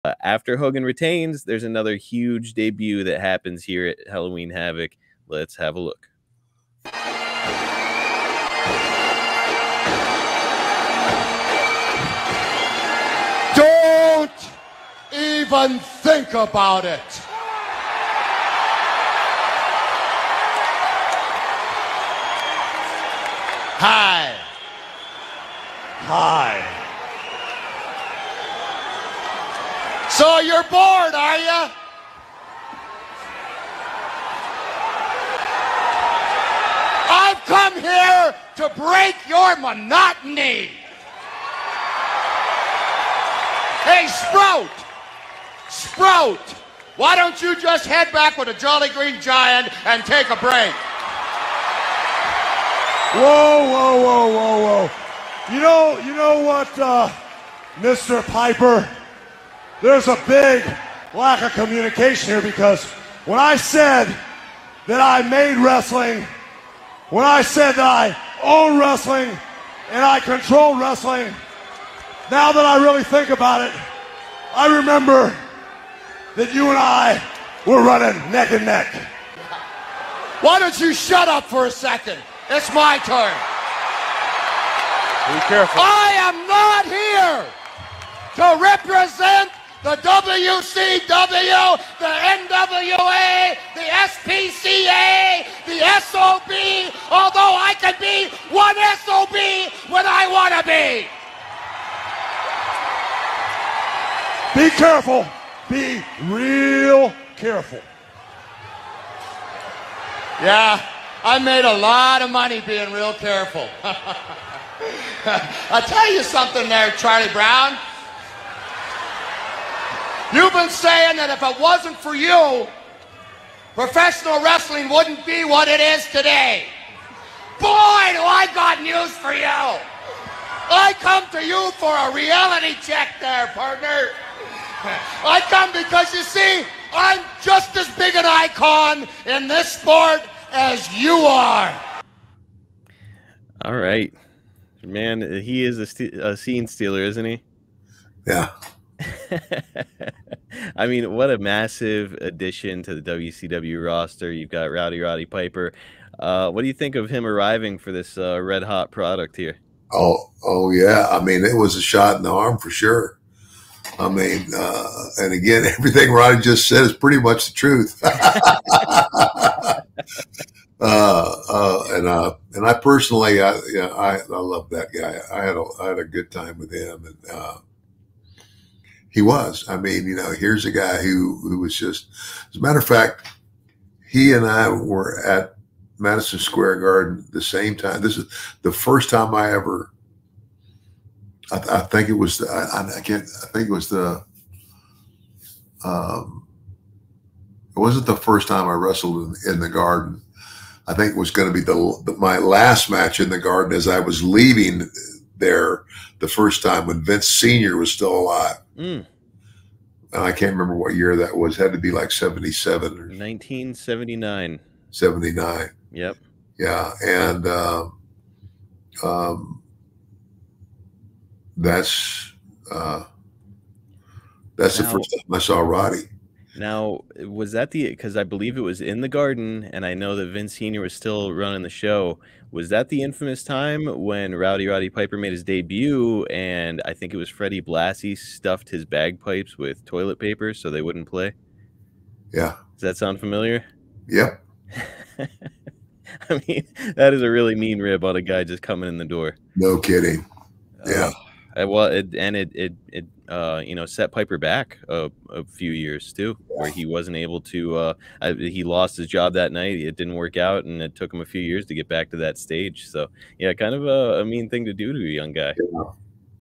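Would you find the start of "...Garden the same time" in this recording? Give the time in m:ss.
3:06.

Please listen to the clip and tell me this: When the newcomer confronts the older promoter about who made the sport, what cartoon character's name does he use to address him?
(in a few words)
Charlie Brown.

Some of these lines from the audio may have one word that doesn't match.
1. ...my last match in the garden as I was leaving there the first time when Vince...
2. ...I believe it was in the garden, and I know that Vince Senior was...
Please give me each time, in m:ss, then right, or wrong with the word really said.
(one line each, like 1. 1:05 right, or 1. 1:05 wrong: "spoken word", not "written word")
1. 3:22 right
2. 3:48 right.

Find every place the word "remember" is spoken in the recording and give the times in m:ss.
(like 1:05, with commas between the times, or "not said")
1:14, 3:30.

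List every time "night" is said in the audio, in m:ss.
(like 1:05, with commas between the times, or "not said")
4:19.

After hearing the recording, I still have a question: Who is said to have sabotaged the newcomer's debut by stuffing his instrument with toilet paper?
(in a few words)
Freddie Blassie.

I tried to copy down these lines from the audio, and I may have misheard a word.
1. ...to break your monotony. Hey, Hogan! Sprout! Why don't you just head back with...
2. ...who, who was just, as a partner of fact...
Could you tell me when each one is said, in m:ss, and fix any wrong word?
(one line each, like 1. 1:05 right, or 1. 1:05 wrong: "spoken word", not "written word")
1. 0:38 wrong: "Sprout", not "Hogan"
2. 3:00 wrong: "matter", not "partner".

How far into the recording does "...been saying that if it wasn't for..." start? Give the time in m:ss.
2:00.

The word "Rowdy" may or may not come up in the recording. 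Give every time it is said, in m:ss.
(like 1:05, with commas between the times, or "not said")
2:34, 3:54.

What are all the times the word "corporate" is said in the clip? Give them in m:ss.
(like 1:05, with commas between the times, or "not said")
not said.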